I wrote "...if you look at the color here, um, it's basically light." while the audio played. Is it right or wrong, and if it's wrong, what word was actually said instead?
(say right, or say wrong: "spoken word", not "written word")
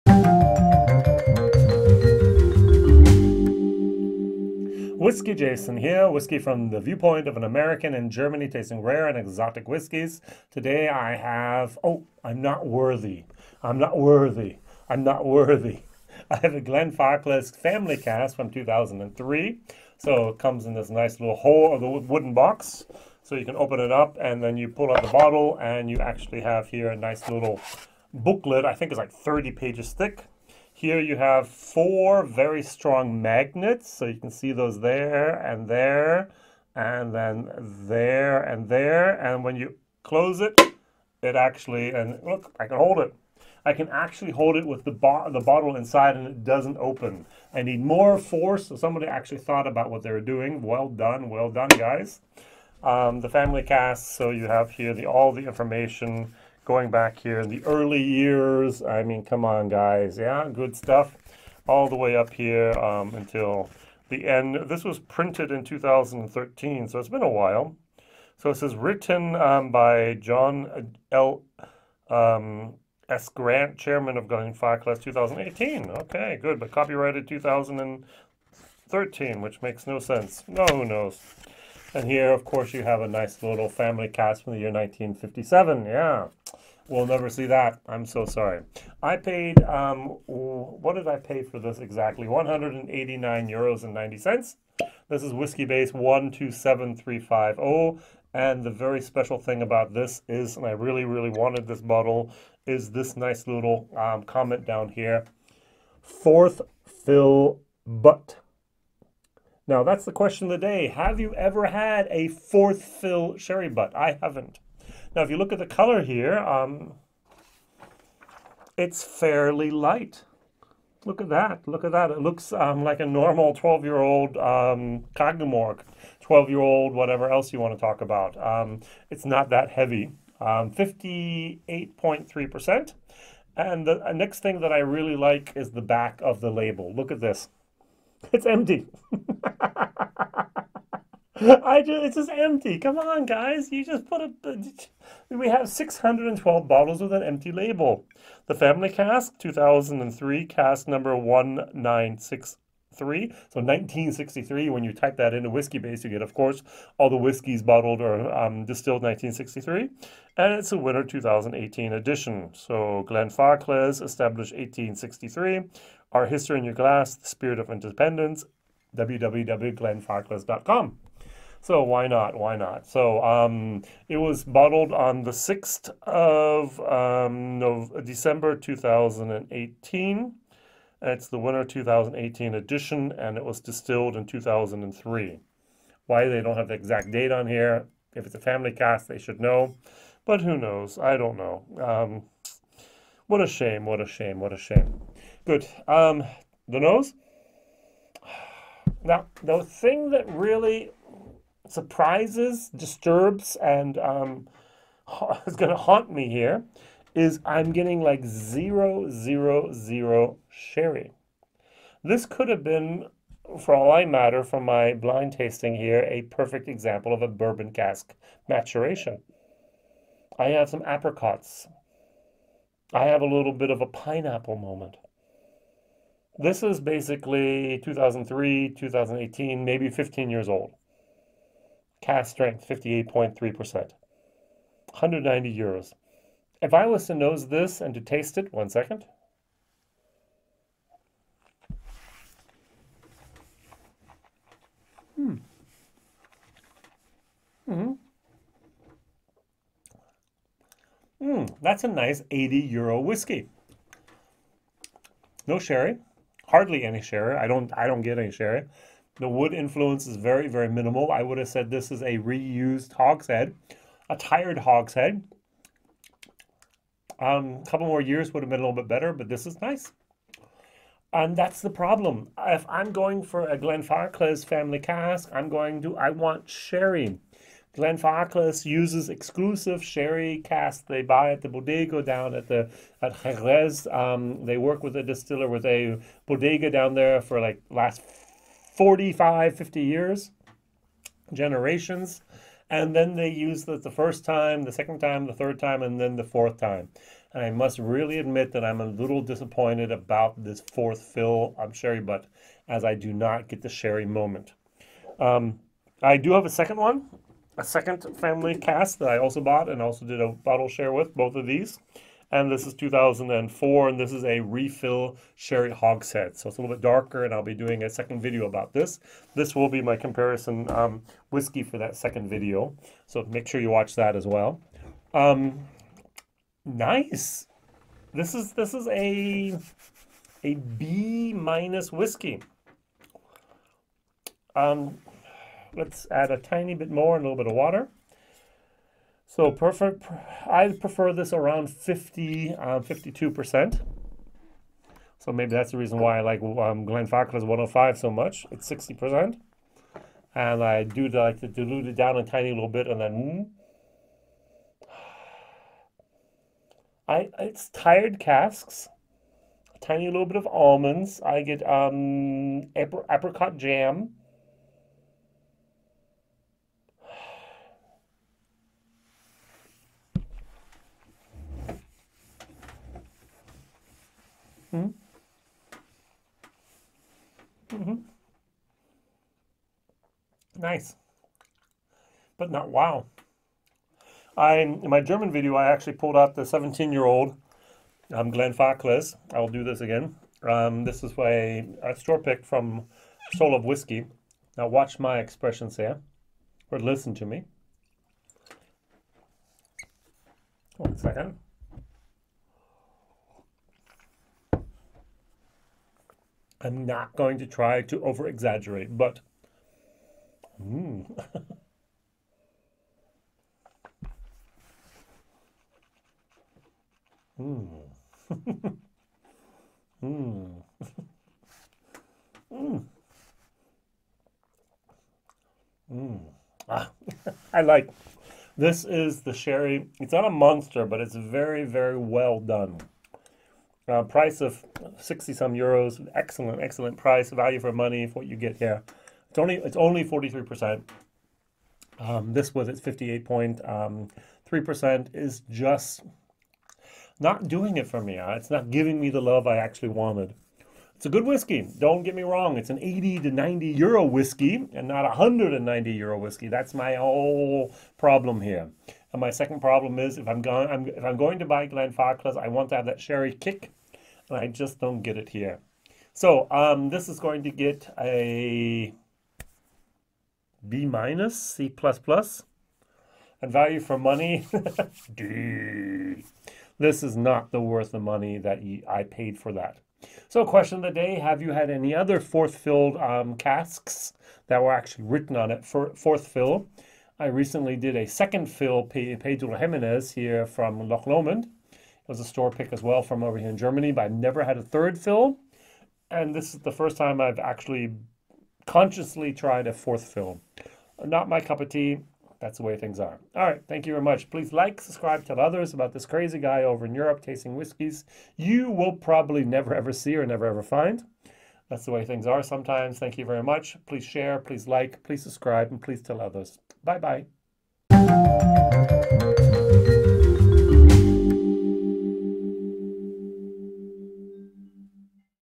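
wrong: "fairly", not "basically".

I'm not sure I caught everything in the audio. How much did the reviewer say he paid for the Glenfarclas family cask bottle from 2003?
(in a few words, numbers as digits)
189 euros and 90 cents.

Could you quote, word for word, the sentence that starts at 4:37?
Glenfarclas uses exclusive sherry casks they buy at the bodega down at the at Jerez.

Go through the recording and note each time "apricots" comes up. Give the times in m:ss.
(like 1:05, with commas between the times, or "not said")
3:40, 6:02.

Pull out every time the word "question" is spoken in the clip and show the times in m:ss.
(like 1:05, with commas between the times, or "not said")
1:50, 8:00.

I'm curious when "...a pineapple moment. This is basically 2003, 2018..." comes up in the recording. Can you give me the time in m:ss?
3:43.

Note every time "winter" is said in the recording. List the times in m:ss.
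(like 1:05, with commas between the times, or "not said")
2:40, 3:01.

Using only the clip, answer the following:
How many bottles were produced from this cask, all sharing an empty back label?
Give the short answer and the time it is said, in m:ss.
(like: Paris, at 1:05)
612, at 2:25.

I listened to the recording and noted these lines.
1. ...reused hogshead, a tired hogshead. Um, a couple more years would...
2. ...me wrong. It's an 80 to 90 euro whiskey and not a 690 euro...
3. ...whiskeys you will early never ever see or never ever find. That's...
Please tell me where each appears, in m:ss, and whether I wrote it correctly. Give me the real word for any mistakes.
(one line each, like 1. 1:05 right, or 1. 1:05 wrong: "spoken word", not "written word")
1. 4:22 right
2. 7:32 wrong: "190", not "690"
3. 8:27 wrong: "probably", not "early".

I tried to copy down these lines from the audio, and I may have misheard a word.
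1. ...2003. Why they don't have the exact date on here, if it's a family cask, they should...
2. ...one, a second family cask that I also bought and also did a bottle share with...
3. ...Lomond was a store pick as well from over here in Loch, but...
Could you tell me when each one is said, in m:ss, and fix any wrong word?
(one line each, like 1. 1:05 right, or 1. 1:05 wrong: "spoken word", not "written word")
1. 3:04 right
2. 5:06 right
3. 8:11 wrong: "Germany", not "Loch".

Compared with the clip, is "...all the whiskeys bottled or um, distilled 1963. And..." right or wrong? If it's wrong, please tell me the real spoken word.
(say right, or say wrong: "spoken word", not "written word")
right.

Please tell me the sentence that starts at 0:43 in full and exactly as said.
I can actually hold it with the, bo the bottle inside and it doesn't open.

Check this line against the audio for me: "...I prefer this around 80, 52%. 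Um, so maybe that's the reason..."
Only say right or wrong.
wrong.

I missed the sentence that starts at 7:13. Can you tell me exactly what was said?
Uh, price of 60 some euros, excellent, excellent price, value for money for what you get here.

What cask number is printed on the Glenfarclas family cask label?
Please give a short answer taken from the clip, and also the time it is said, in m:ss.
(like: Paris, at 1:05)
1963, at 2:30.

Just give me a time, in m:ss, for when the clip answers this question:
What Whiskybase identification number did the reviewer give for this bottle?
1:35.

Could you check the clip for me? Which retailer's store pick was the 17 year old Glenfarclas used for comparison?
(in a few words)
Soul of Whiskey.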